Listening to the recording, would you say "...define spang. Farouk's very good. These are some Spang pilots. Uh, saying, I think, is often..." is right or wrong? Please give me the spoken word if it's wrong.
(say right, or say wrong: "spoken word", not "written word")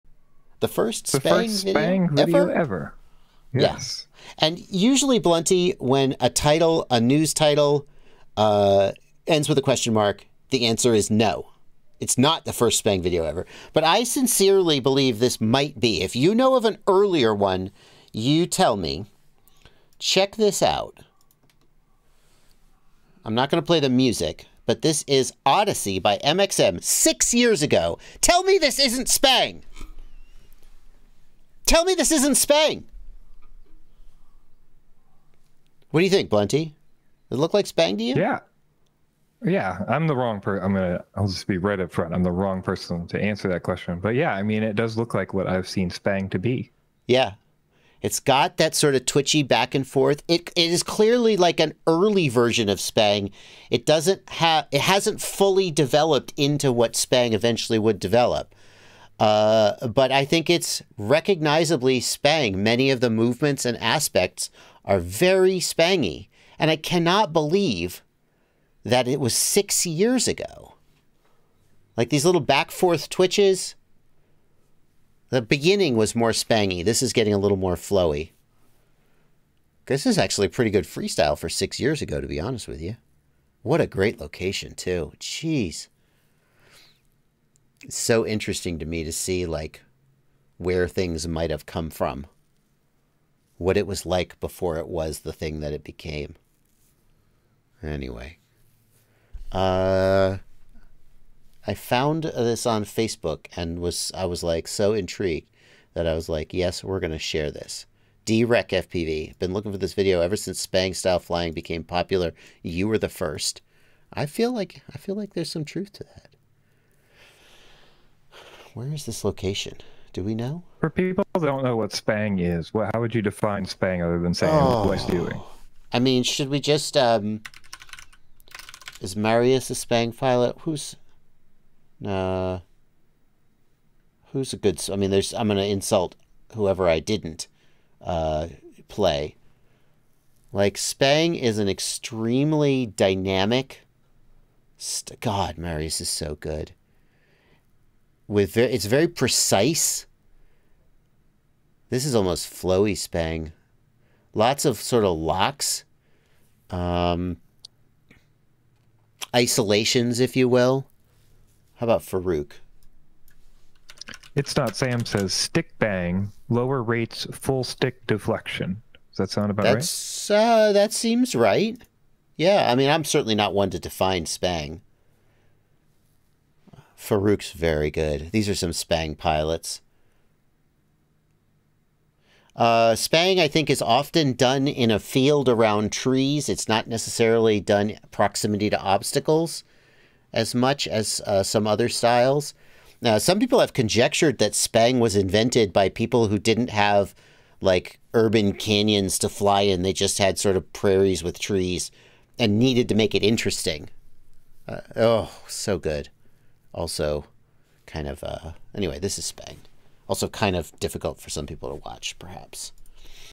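wrong: "spang", not "saying".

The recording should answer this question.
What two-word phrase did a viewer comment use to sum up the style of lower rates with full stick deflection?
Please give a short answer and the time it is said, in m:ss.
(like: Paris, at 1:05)
stick bang, at 2:45.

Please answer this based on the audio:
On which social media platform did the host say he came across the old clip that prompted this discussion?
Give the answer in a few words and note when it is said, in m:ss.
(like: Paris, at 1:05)
Facebook, at 1:42.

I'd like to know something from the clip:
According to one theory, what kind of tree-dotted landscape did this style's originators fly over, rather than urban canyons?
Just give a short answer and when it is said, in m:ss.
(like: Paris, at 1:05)
prairies, at 3:20.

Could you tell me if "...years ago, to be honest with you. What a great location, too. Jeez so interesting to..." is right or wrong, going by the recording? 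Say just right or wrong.
right.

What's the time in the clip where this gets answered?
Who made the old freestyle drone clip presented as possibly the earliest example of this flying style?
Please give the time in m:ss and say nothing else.
0:26.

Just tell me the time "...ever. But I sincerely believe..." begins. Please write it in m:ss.
0:13.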